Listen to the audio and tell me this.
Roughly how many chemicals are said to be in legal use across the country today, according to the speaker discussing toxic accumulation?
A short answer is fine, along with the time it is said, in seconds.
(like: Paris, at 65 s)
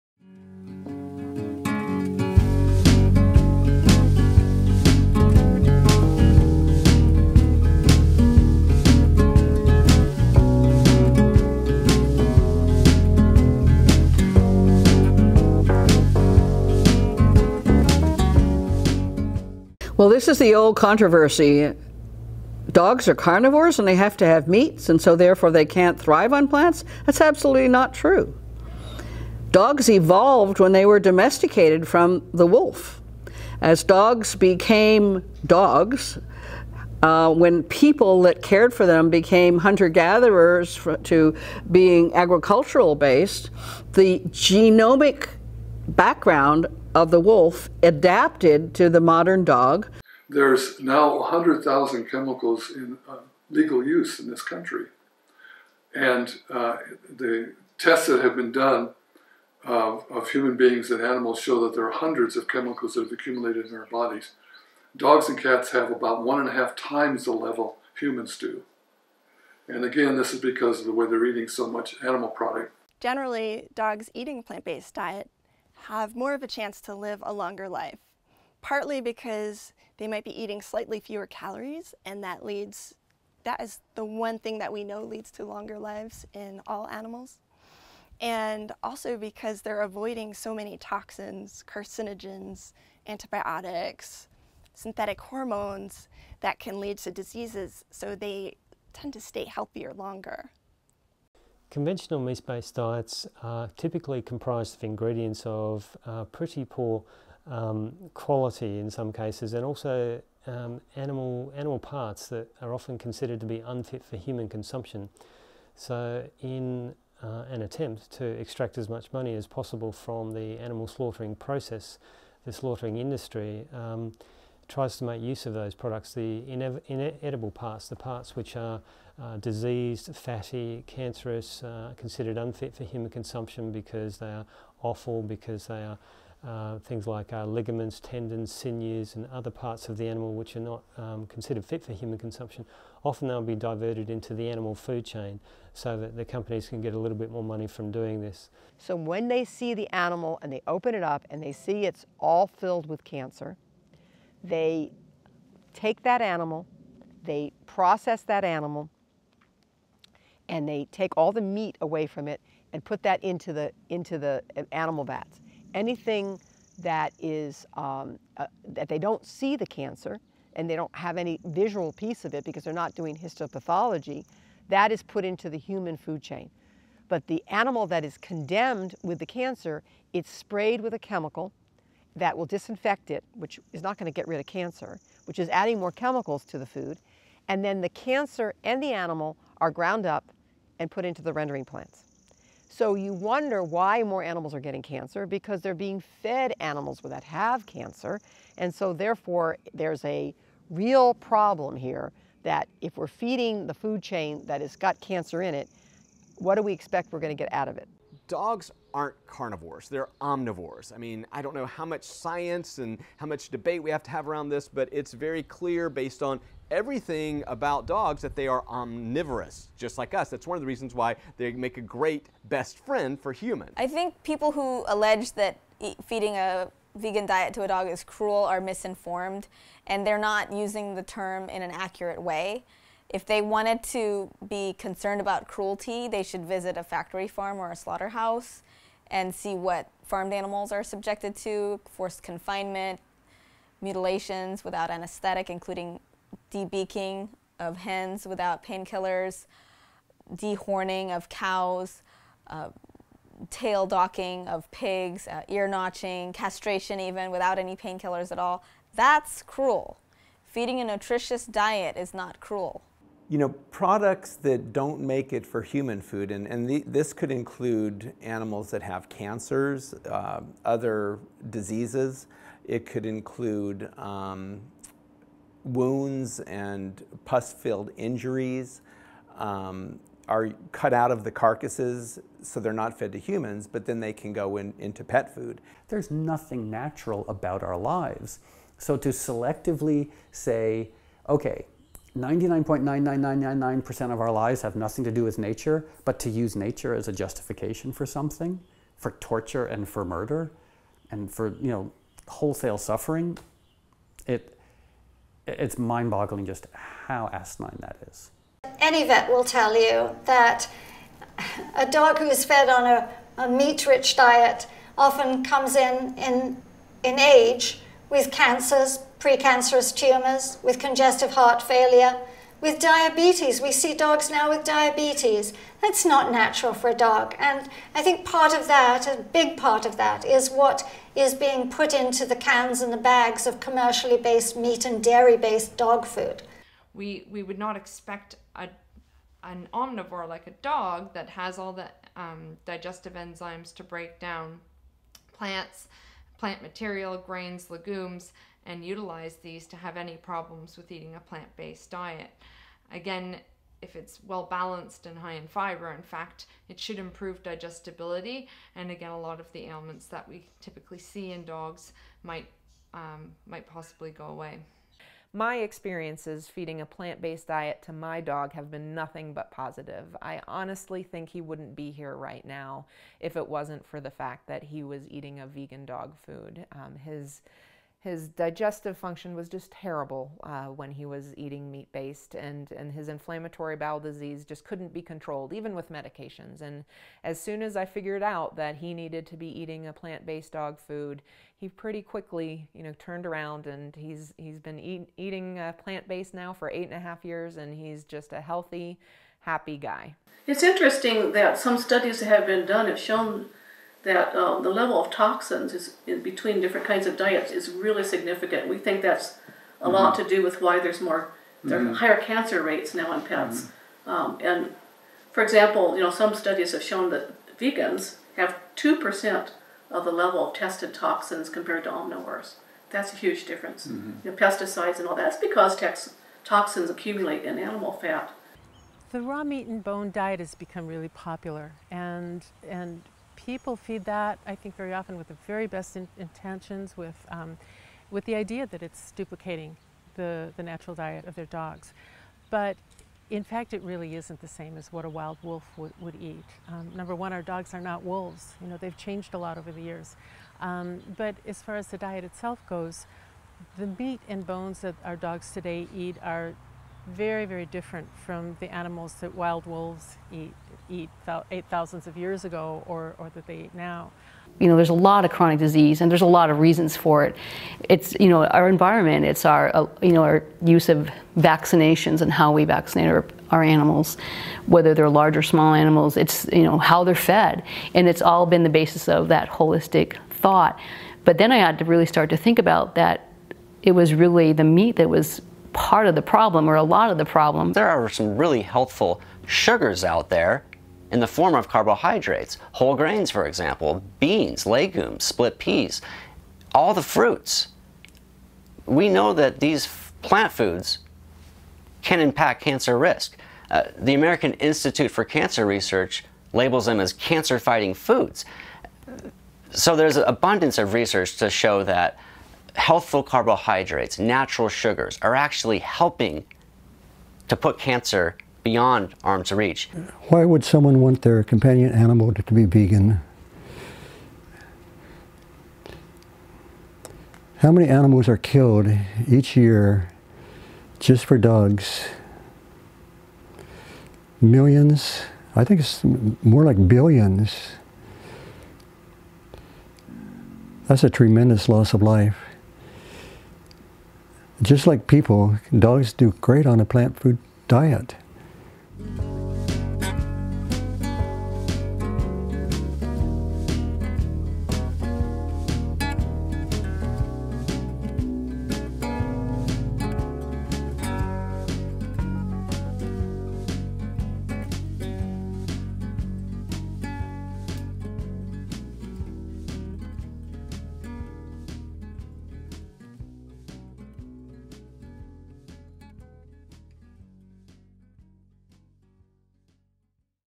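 100,000, at 51 s.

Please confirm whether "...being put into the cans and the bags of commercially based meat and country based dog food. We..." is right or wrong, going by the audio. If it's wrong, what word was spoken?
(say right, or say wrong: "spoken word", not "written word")
wrong: "dairy", not "country".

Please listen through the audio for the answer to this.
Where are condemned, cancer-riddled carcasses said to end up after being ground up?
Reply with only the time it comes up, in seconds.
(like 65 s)
191 s.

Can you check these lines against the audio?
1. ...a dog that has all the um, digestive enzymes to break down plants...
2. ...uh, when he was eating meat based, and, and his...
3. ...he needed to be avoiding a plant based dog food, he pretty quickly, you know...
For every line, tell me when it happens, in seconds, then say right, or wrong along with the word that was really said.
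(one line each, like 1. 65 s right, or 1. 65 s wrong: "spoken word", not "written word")
1. 340 s right
2. 380 s right
3. 388 s wrong: "eating", not "avoiding".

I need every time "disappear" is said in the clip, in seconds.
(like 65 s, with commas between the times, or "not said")
not said.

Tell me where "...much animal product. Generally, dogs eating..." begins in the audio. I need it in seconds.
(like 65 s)
71 s.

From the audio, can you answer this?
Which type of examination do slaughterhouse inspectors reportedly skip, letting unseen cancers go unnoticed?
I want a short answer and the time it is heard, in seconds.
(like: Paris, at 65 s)
Histopathology, at 173 s.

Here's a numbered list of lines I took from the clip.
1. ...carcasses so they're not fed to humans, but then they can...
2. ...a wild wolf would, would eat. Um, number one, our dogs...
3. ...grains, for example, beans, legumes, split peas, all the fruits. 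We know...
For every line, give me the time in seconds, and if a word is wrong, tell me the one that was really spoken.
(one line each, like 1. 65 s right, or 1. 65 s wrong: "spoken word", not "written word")
1. 281 s right
2. 445 s right
3. 492 s right.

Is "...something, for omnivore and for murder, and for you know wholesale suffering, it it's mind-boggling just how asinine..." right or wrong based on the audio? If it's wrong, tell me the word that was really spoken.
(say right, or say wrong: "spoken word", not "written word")
wrong: "torture", not "omnivore".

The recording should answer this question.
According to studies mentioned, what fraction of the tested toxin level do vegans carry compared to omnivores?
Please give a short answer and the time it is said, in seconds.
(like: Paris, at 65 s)
2 percent, at 418 s.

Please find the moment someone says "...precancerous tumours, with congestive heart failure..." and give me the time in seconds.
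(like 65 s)
319 s.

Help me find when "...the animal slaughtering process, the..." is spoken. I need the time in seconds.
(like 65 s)
120 s.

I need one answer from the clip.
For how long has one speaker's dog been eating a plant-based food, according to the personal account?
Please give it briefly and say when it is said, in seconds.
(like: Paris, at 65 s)
Eight and a half years, at 396 s.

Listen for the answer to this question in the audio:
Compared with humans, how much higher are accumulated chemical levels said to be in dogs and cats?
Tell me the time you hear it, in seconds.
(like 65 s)
66 s.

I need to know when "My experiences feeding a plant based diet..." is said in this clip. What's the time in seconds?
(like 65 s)
365 s.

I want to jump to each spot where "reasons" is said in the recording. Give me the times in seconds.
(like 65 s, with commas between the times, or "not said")
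220 s, 466 s.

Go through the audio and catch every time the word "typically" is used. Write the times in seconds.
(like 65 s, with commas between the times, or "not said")
103 s, 360 s.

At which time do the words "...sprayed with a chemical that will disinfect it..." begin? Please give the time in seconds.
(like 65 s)
180 s.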